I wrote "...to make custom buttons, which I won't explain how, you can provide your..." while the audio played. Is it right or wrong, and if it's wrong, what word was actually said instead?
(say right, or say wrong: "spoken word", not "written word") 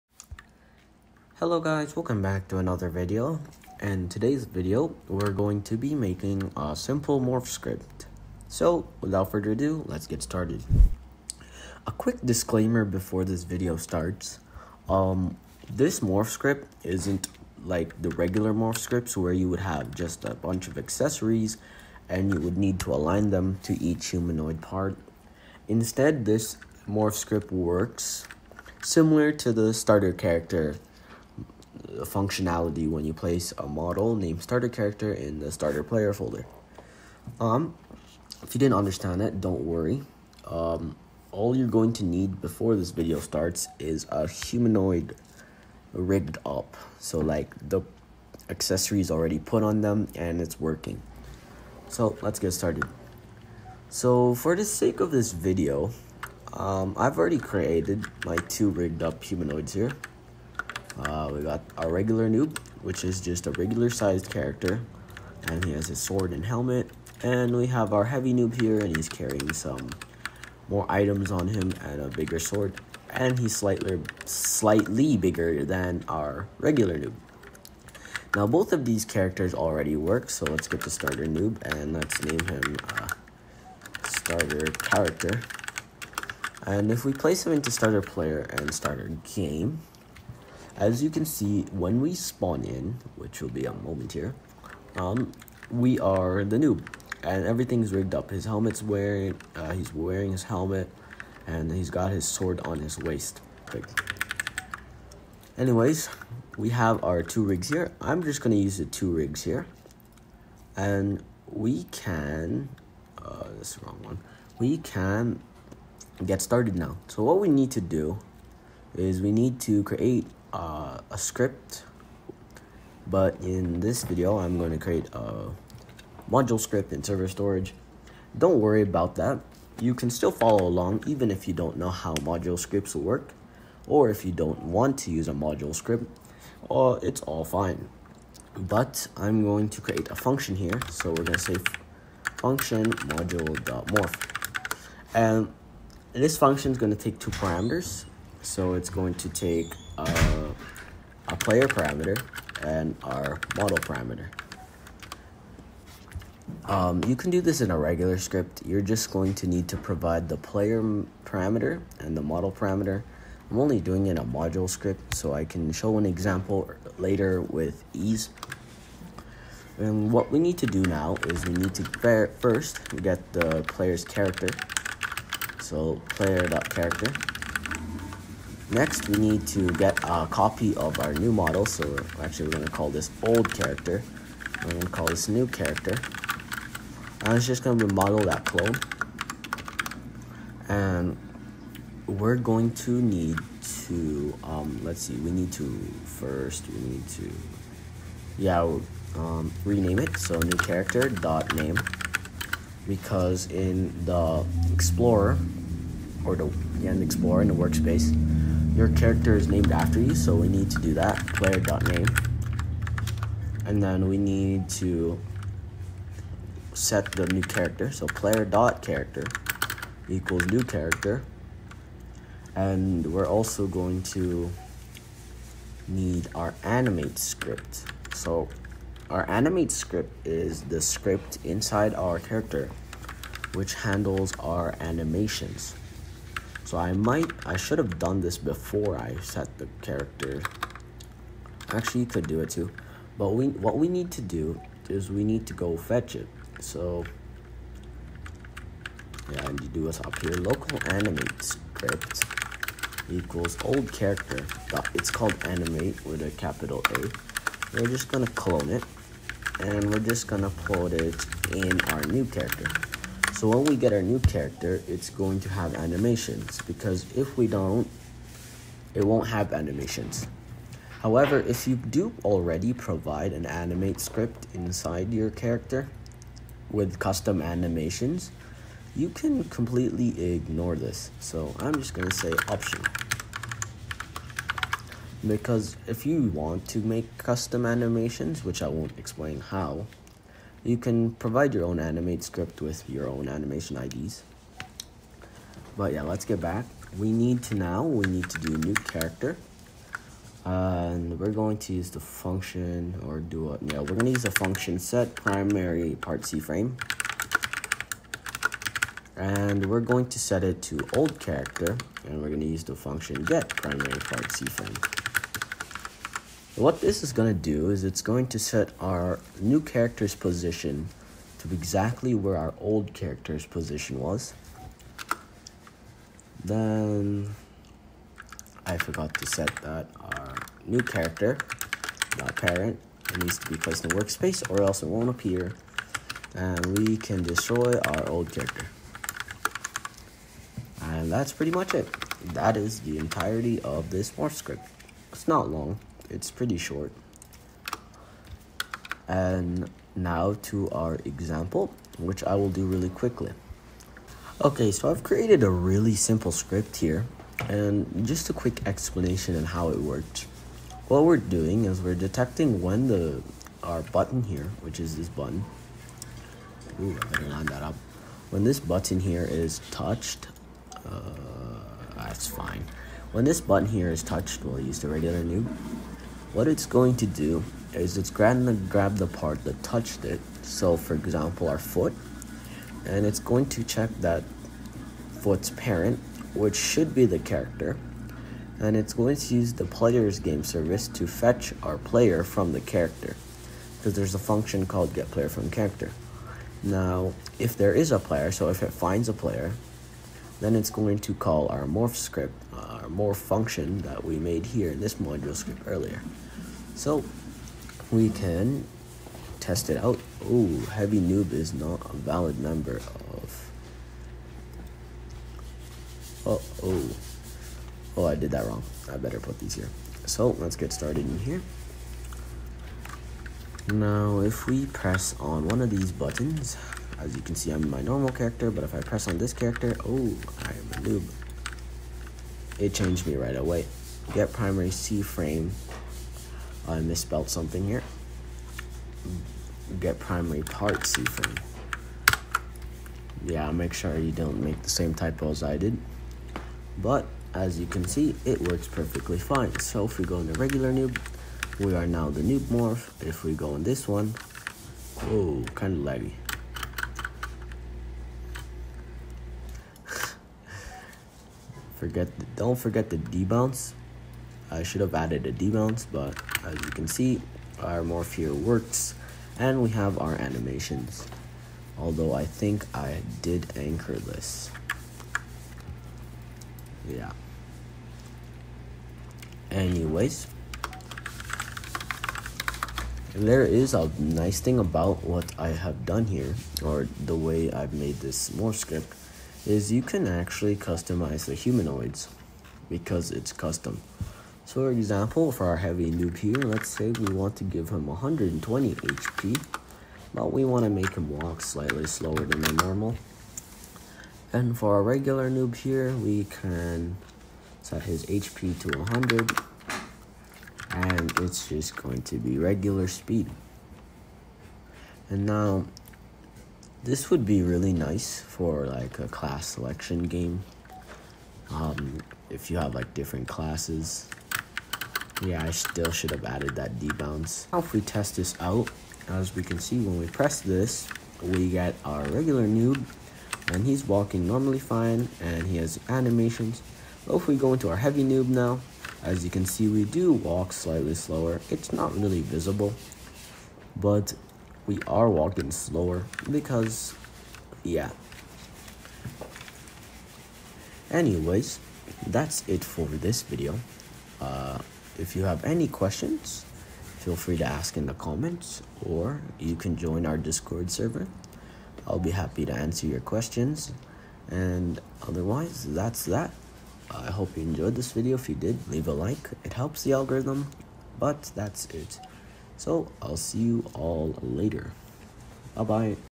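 wrong: "animations", not "buttons".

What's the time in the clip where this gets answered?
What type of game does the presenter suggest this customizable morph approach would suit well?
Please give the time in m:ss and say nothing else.
8:39.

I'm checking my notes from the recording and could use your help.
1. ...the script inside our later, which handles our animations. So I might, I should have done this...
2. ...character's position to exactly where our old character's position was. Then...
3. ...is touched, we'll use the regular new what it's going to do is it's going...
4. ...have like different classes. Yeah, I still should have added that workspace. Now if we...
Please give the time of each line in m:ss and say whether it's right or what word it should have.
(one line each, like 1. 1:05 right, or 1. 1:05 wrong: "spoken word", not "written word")
1. 3:50 wrong: "character", not "later"
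2. 5:19 right
3. 6:13 right
4. 8:42 wrong: "debounce", not "workspace".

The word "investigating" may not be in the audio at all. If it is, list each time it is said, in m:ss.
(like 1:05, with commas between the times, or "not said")
not said.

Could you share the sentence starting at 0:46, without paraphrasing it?
So like the accessories already put on them and it's working.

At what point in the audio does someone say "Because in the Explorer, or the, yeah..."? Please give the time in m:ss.
3:22.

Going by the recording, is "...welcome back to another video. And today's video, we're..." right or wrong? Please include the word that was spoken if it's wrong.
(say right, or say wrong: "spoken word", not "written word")
right.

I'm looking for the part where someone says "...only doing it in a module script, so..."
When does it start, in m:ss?
2:43.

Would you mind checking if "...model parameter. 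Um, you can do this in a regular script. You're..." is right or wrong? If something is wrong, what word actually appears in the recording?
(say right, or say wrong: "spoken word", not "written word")
right.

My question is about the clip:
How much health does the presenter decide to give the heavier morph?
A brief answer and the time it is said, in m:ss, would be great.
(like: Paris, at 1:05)
120, at 8:17.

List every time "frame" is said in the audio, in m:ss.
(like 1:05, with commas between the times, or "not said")
5:06, 5:14, 7:15, 7:21.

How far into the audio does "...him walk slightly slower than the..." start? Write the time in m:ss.
8:20.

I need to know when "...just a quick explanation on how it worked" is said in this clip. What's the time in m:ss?
5:58.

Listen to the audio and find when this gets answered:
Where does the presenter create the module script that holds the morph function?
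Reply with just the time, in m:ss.
2:07.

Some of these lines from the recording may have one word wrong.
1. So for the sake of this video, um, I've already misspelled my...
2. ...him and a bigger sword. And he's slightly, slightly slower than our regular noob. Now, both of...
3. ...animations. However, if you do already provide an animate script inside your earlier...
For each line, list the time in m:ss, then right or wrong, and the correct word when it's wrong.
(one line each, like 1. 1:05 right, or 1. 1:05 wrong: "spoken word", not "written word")
1. 0:53 wrong: "created", not "misspelled"
2. 1:11 wrong: "bigger", not "slower"
3. 4:29 wrong: "character", not "earlier".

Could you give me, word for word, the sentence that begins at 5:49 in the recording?
And now to our example, which I will do really quickly.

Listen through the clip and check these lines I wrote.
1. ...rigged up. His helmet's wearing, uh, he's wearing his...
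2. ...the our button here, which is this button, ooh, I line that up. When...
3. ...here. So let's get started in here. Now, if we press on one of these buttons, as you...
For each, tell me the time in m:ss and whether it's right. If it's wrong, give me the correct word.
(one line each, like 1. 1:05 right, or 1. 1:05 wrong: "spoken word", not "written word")
1. 1:37 right
2. 6:02 right
3. 6:59 right.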